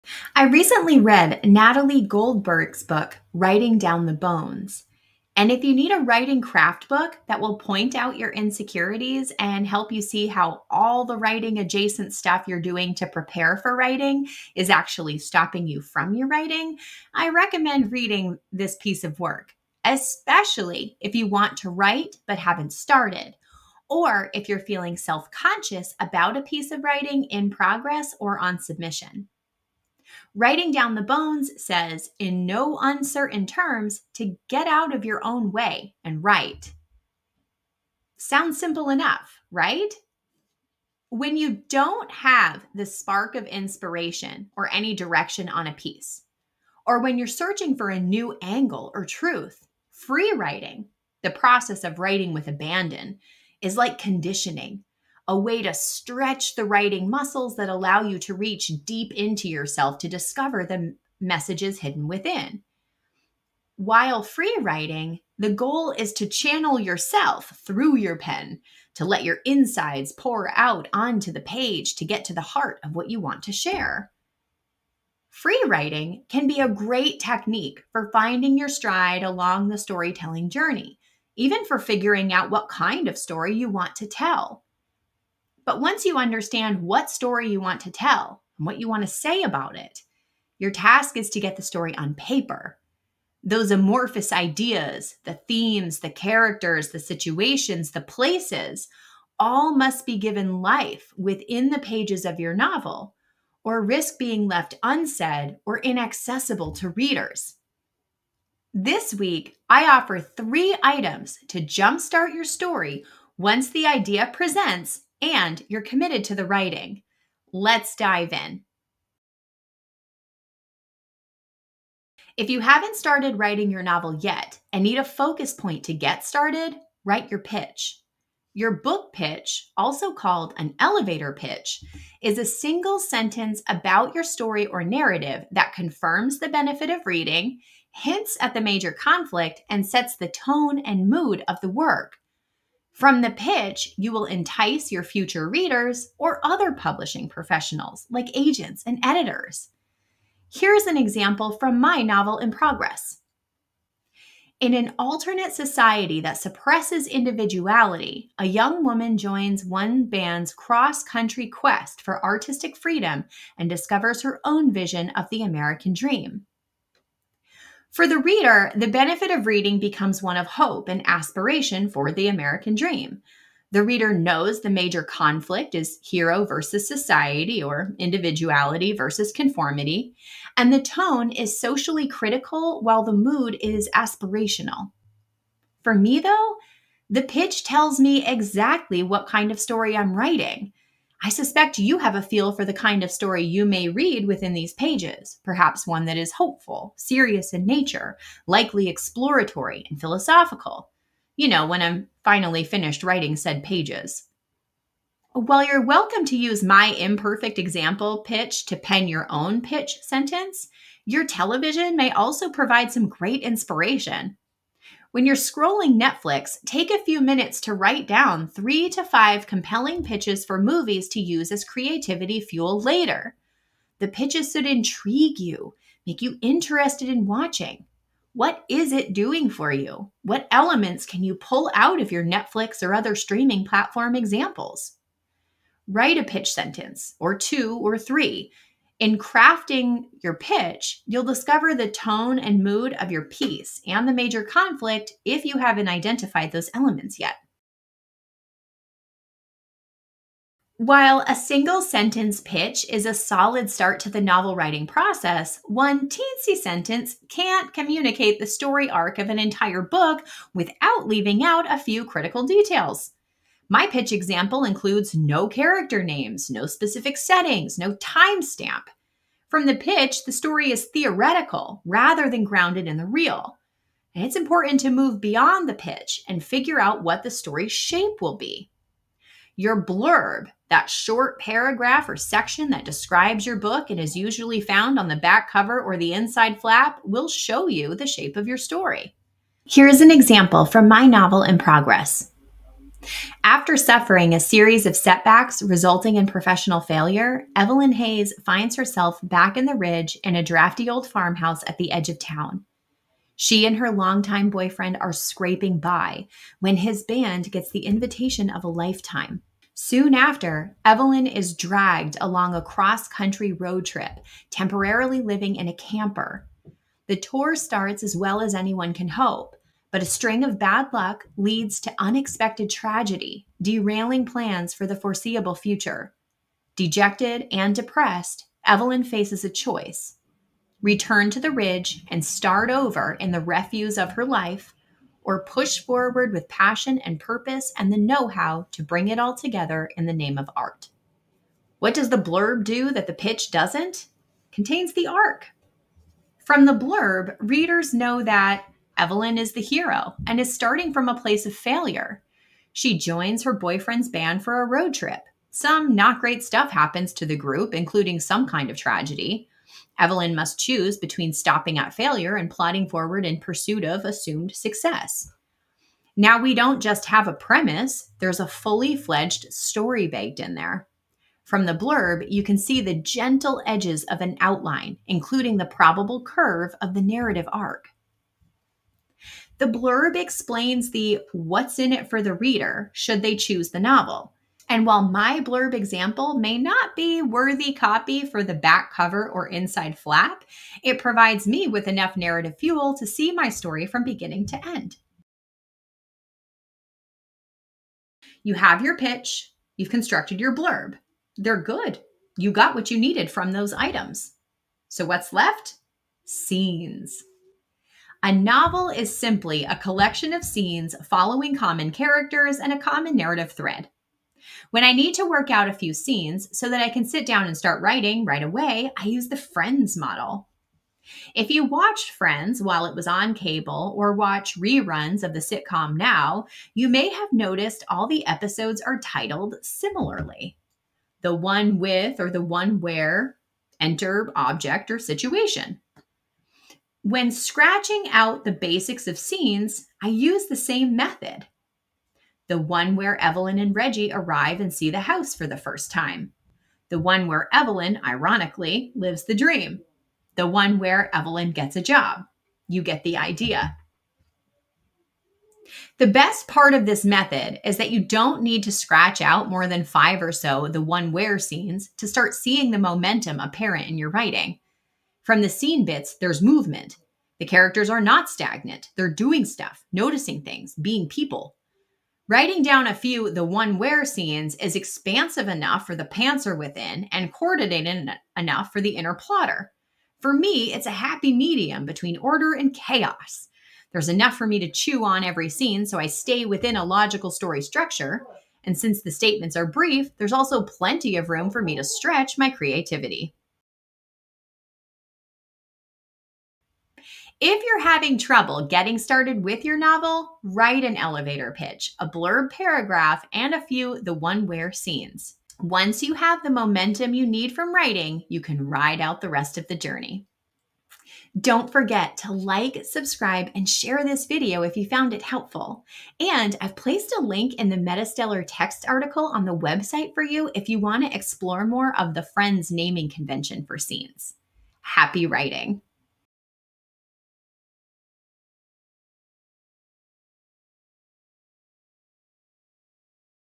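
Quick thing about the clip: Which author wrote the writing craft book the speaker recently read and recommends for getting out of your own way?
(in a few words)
Natalie Goldberg.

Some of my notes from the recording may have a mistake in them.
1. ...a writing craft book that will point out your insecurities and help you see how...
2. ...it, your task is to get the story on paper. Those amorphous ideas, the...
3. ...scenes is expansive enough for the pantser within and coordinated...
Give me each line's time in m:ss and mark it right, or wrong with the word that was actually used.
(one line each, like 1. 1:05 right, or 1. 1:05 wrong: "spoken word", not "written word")
1. 0:05 right
2. 1:29 right
3. 7:54 right.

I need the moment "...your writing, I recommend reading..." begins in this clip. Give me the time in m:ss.
0:16.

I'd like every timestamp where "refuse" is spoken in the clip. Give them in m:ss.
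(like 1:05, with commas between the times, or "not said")
5:33.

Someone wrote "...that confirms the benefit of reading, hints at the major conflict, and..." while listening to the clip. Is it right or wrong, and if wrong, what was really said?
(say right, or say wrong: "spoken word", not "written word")
right.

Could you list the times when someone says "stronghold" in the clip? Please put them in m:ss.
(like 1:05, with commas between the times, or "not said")
not said.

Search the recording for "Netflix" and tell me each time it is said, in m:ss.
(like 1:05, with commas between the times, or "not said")
3:36, 3:52.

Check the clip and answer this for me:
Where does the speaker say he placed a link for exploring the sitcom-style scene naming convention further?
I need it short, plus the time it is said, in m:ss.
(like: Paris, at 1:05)
Metastellar text article, at 8:37.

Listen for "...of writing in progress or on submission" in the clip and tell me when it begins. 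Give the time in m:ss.
0:26.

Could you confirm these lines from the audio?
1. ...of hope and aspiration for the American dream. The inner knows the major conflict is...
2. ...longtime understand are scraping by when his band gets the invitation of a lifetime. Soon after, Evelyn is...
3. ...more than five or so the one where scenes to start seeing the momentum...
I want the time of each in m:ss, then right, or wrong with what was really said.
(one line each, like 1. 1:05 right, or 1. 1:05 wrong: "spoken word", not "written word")
1. 2:50 wrong: "reader", not "inner"
2. 5:03 wrong: "boyfriend", not "understand"
3. 7:39 right.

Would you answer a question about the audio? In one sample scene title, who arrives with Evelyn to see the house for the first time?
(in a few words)
Reggie.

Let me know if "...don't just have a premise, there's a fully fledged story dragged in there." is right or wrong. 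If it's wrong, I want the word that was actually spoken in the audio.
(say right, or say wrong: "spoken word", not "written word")
wrong: "baked", not "dragged".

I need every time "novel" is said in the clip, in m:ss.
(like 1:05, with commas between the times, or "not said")
1:42, 2:03, 2:32, 4:14, 4:51, 6:23, 6:48, 8:19.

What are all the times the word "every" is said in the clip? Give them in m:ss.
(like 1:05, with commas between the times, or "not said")
8:05.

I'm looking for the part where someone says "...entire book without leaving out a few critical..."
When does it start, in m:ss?
4:19.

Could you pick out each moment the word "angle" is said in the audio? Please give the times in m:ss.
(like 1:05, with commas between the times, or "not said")
0:48.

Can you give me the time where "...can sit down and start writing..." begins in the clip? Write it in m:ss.
6:56.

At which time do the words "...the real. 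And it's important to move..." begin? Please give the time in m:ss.
4:32.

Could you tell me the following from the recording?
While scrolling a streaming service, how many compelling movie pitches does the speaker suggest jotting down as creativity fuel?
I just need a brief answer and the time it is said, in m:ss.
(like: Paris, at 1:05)
3 to 5, at 3:38.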